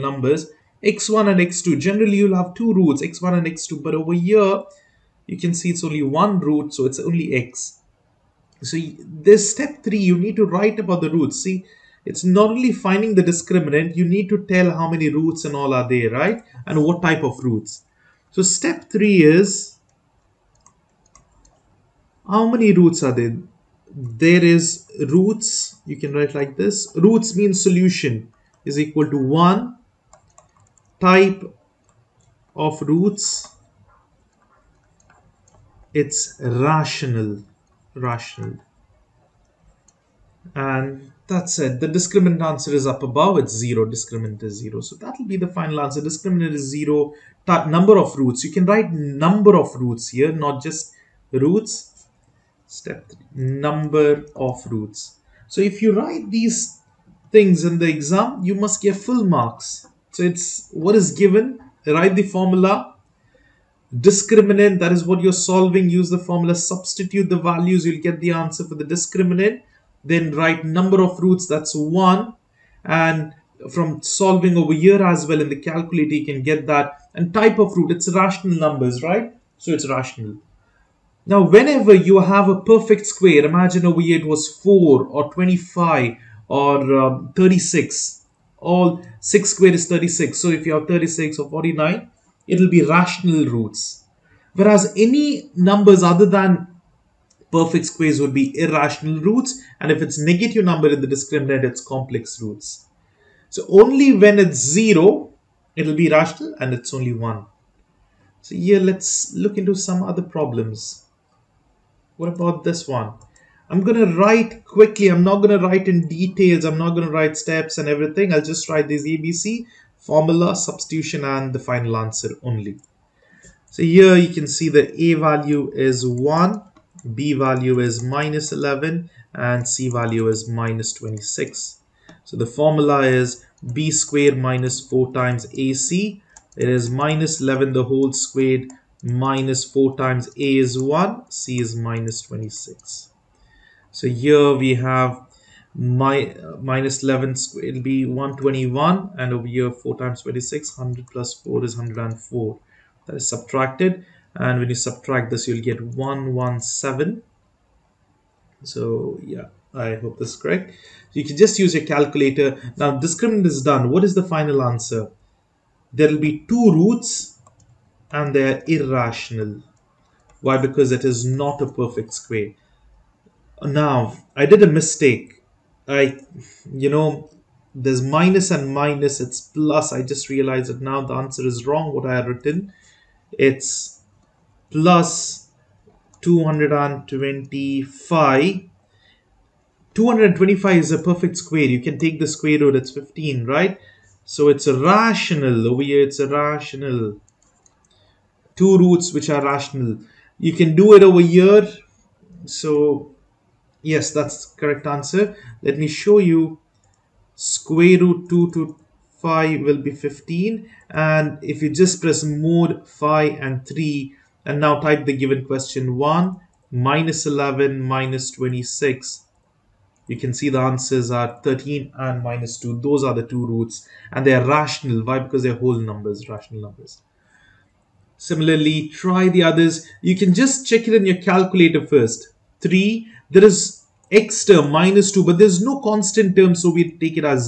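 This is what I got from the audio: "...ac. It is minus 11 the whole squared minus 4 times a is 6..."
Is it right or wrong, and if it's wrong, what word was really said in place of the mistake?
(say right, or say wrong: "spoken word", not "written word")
wrong: "1", not "6".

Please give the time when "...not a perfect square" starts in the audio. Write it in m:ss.
2:51.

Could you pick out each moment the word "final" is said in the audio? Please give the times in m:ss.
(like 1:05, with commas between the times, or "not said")
0:45, 2:01, 2:44.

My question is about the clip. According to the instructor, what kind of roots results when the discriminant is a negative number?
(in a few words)
complex roots.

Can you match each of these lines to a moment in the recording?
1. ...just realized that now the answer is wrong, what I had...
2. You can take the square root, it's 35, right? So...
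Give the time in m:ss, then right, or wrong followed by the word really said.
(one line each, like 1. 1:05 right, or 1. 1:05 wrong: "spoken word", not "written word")
1. 3:00 right
2. 3:11 wrong: "15", not "35".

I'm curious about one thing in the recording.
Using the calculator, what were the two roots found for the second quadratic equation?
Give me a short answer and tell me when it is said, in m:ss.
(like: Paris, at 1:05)
13 and -2, at 3:41.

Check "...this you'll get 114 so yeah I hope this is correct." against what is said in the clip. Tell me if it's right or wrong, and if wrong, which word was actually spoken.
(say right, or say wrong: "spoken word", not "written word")
wrong: "117", not "114".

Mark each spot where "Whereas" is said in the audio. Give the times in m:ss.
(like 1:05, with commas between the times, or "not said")
1:34.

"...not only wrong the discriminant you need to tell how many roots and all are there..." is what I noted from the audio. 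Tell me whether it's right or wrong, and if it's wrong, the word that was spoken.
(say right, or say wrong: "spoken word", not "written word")
wrong: "finding", not "wrong".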